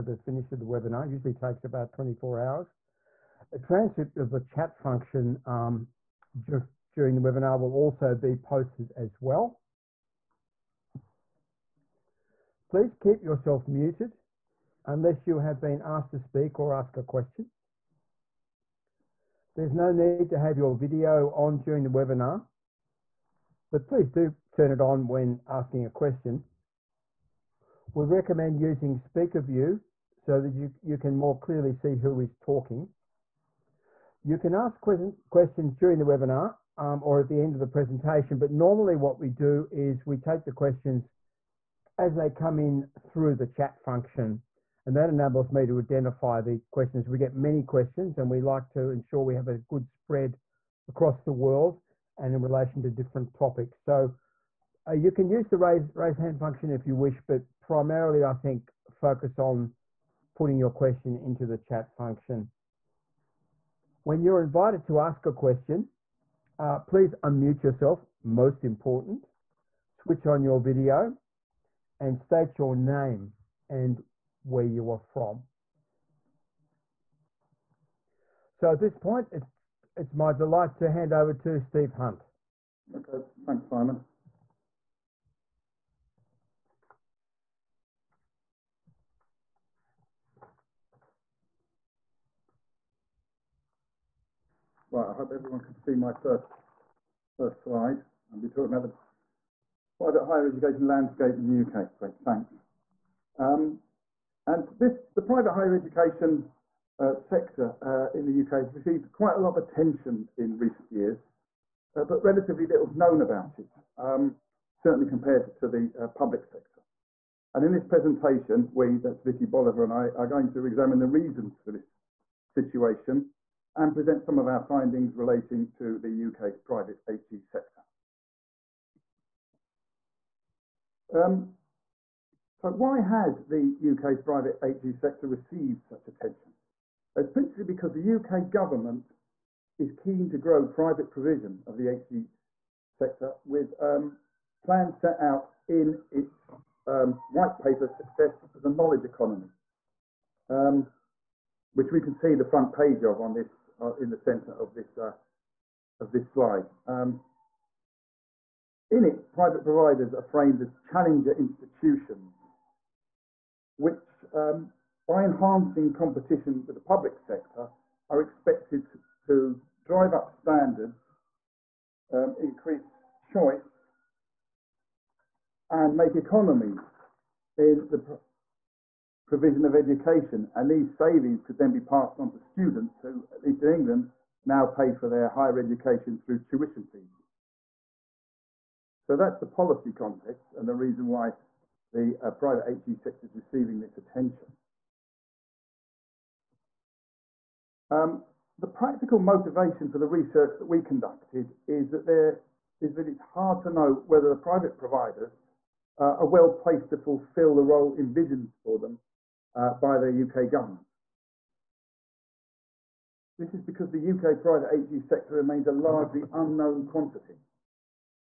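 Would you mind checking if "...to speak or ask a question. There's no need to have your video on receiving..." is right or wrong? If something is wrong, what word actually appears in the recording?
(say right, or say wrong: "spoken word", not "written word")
wrong: "during", not "receiving".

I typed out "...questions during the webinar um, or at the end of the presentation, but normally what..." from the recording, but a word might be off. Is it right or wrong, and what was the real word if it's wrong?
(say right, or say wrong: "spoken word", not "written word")
right.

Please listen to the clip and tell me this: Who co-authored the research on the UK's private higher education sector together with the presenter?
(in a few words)
Vikki Boliver.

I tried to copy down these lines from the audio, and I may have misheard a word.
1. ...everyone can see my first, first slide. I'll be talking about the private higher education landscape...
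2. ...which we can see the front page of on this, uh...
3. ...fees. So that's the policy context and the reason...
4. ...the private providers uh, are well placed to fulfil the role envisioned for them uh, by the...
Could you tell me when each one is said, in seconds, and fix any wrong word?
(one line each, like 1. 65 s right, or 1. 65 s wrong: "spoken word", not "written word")
1. 95 s right
2. 151 s right
3. 186 s right
4. 204 s right.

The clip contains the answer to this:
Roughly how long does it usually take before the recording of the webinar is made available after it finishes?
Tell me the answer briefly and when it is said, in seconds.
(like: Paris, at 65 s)
24 hours, at 1 s.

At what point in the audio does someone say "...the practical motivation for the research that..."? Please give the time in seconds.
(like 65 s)
198 s.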